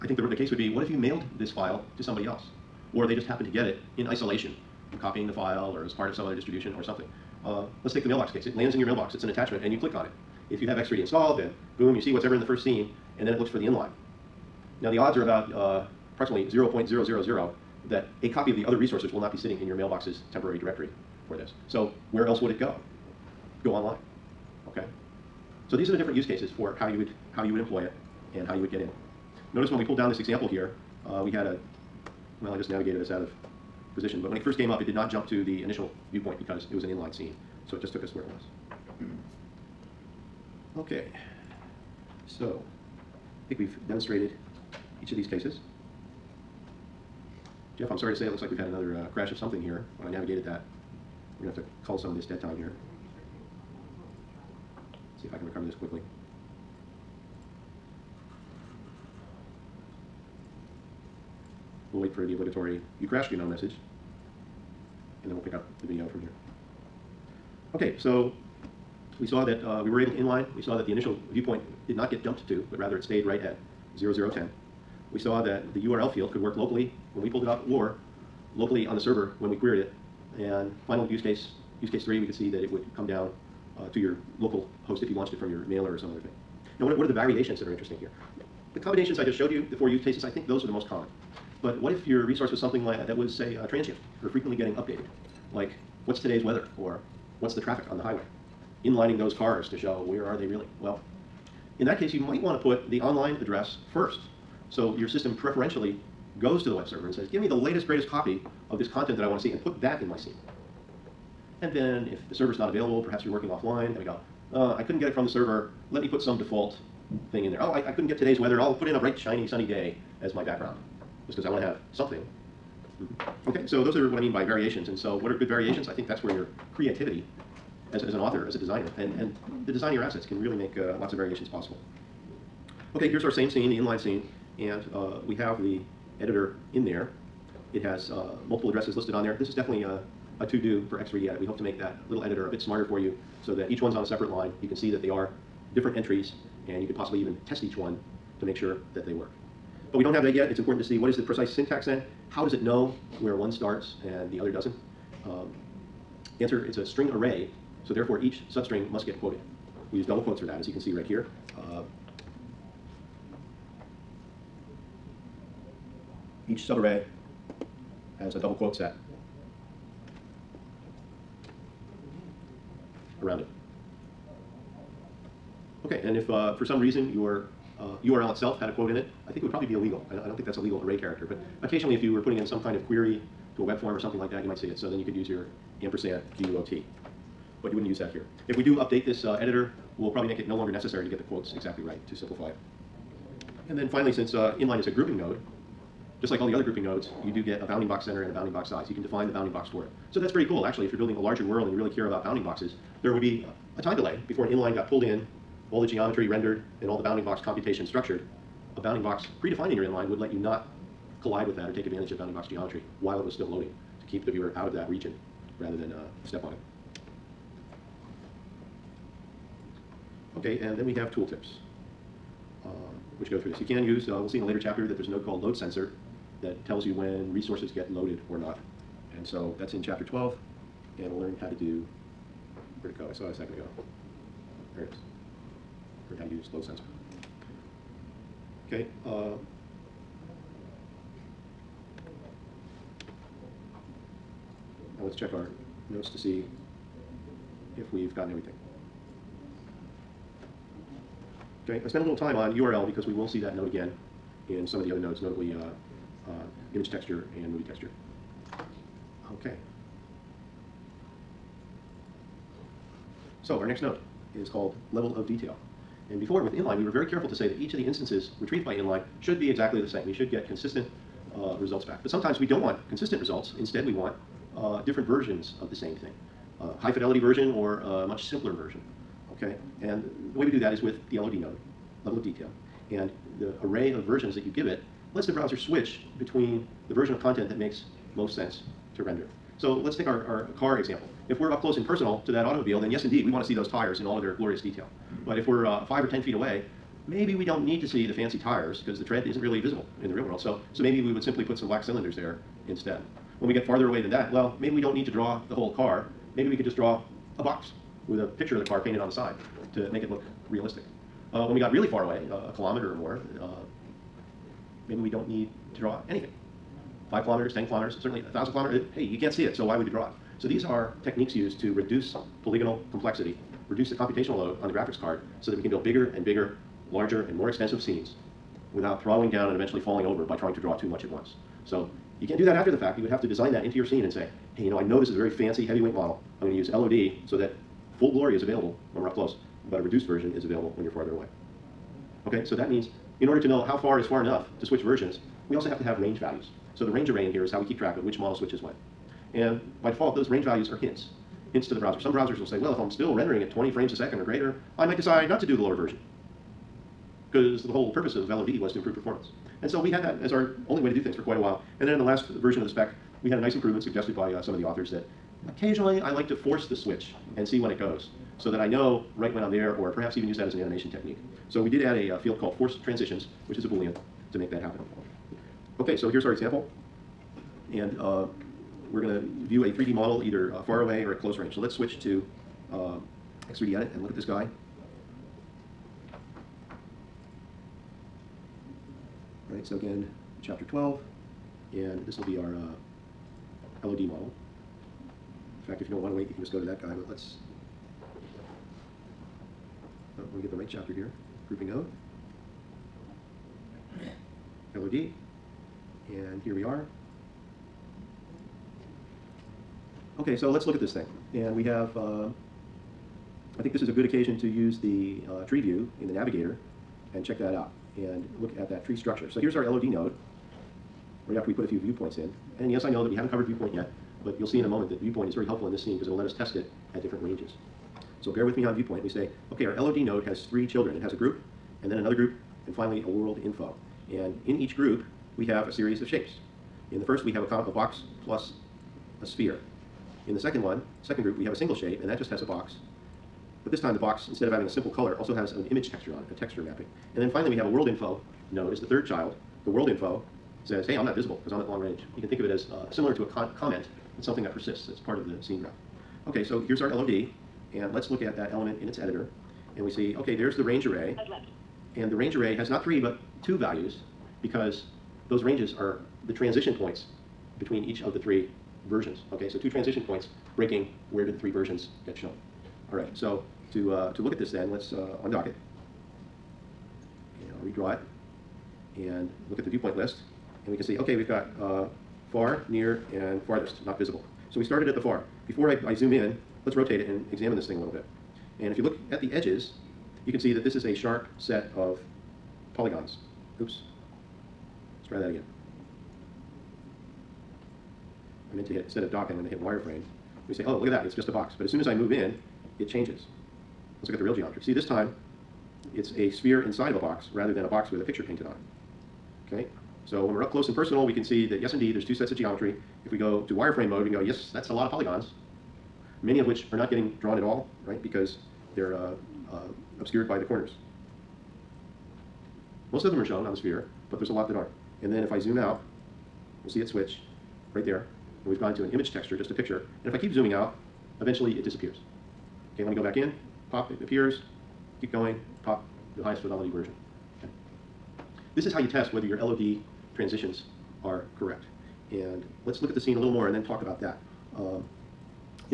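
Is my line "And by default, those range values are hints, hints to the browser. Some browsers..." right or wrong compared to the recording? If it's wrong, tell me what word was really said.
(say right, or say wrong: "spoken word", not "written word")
right.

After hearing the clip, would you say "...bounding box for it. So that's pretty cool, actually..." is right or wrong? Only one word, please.
right.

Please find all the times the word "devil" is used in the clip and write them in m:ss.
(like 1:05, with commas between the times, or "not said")
not said.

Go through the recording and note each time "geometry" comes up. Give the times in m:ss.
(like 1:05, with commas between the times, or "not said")
3:25, 3:32, 8:24, 8:32.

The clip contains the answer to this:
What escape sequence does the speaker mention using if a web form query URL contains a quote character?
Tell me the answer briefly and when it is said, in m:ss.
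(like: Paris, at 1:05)
ampersand QUOT, at 3:05.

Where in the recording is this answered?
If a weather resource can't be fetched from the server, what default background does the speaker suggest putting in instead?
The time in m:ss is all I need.
1:58.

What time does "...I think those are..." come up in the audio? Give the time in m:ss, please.
1:30.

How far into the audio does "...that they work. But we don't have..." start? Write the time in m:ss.
2:28.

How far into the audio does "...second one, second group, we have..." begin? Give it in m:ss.
7:20.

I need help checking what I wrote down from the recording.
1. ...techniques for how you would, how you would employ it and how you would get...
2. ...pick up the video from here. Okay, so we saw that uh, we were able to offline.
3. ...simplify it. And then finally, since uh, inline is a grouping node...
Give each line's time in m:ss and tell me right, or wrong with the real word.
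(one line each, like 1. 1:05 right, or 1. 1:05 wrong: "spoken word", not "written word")
1. 0:26 wrong: "cases", not "techniques"
2. 1:05 wrong: "inline", not "offline"
3. 3:12 right.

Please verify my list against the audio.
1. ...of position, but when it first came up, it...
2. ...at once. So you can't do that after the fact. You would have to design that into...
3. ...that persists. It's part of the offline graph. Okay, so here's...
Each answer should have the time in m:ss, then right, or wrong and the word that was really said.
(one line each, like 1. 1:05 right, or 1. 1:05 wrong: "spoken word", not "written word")
1. 0:33 right
2. 5:31 right
3. 7:34 wrong: "scene", not "offline".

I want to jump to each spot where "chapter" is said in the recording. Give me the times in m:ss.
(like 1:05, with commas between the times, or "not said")
3:44, 3:49, 6:30, 6:40.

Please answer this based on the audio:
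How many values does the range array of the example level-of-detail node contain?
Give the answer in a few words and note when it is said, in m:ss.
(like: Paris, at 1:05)
2, at 7:43.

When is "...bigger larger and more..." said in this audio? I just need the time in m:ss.
5:26.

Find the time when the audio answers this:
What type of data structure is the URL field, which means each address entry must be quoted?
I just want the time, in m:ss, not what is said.
2:36.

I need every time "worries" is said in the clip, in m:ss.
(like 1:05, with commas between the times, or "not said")
not said.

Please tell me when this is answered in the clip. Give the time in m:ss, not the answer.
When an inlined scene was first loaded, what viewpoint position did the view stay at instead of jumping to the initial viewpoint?
1:13.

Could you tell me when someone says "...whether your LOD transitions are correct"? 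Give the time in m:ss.
8:59.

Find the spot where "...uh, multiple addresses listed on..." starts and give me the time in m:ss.
2:18.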